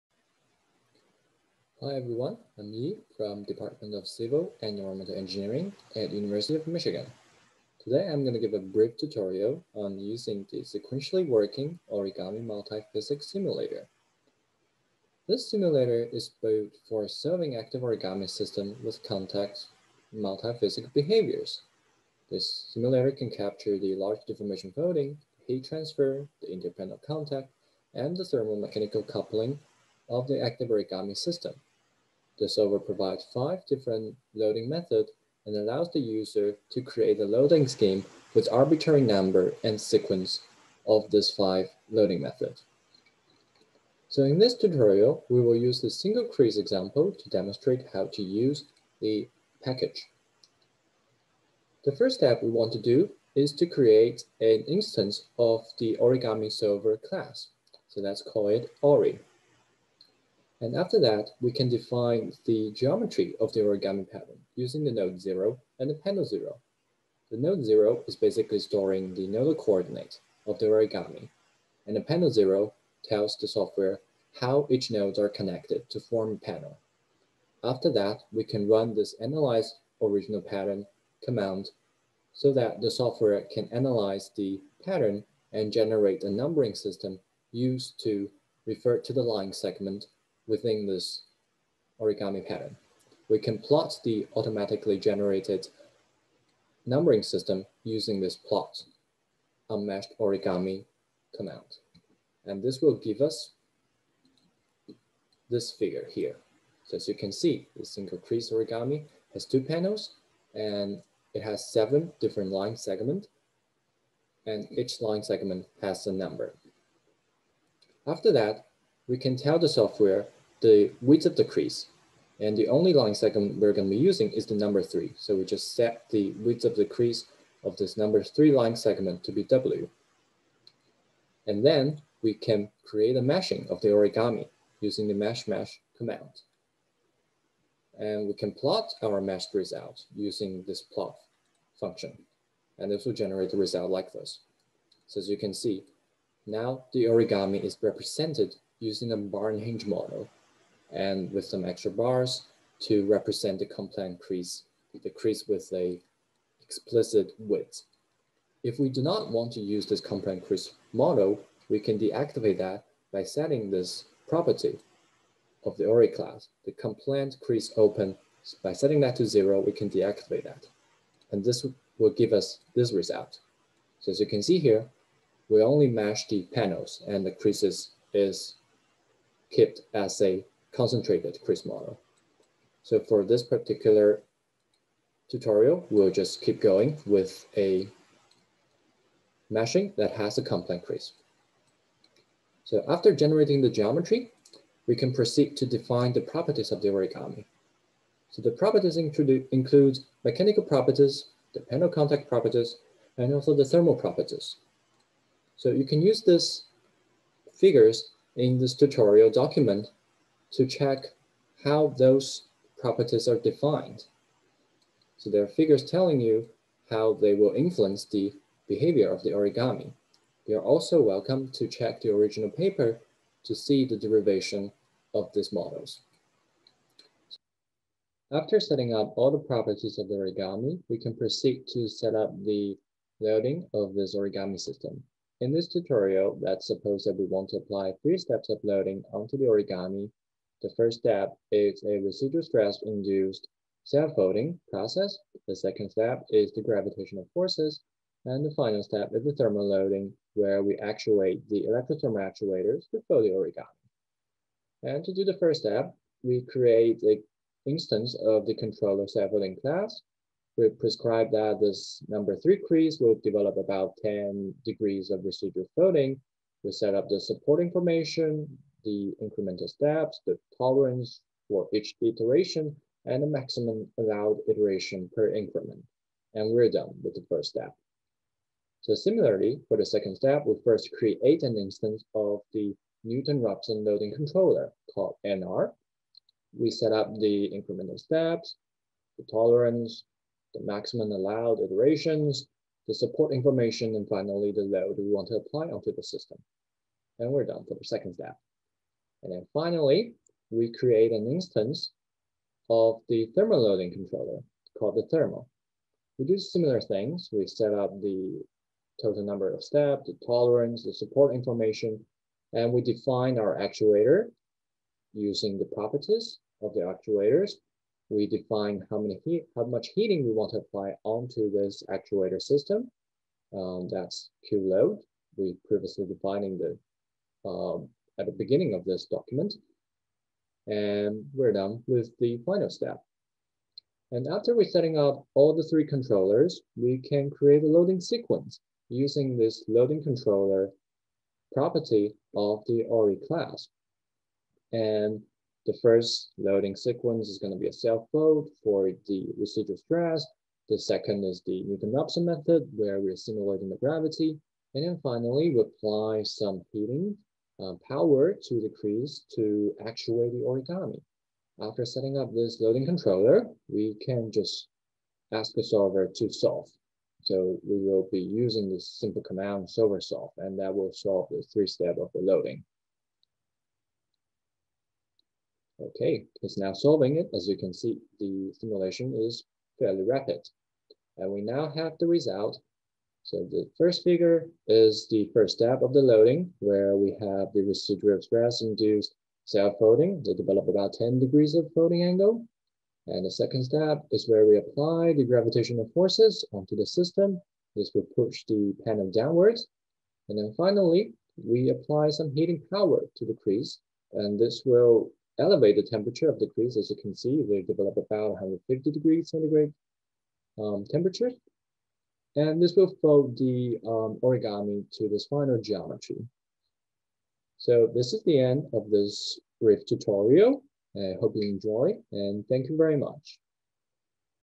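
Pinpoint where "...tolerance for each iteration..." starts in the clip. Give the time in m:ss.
4:30.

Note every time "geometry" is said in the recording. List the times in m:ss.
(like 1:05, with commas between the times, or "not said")
1:02, 3:13, 6:55.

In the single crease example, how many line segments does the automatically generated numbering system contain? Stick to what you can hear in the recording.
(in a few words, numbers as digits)
7.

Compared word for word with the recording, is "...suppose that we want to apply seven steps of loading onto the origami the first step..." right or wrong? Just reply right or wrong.
wrong.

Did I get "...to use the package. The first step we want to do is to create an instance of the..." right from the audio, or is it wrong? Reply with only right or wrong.
right.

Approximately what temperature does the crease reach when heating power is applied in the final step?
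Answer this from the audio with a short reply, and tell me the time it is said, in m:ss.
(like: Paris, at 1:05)
150 degrees centigrade, at 6:48.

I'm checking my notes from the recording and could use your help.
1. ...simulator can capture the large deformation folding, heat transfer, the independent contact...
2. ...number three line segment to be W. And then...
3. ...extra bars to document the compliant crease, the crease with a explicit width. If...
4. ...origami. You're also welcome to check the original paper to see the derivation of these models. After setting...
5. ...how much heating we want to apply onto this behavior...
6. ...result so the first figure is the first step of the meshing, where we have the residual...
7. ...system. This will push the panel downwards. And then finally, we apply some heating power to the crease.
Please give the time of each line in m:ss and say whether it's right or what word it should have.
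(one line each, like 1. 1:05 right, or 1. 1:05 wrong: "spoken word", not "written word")
1. 0:22 right
2. 2:07 right
3. 2:31 wrong: "represent", not "document"
4. 3:39 right
5. 5:19 wrong: "actuator", not "behavior"
6. 6:22 wrong: "loading", not "meshing"
7. 6:36 right.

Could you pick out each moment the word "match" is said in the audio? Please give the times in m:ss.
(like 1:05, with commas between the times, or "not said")
2:55.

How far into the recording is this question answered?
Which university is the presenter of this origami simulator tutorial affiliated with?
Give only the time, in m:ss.
0:06.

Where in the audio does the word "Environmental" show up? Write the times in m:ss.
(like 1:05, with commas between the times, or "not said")
0:04.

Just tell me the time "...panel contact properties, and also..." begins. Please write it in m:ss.
3:21.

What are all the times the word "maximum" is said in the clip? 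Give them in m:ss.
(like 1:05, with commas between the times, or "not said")
4:33, 4:50.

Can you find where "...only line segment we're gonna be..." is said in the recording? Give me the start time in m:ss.
2:02.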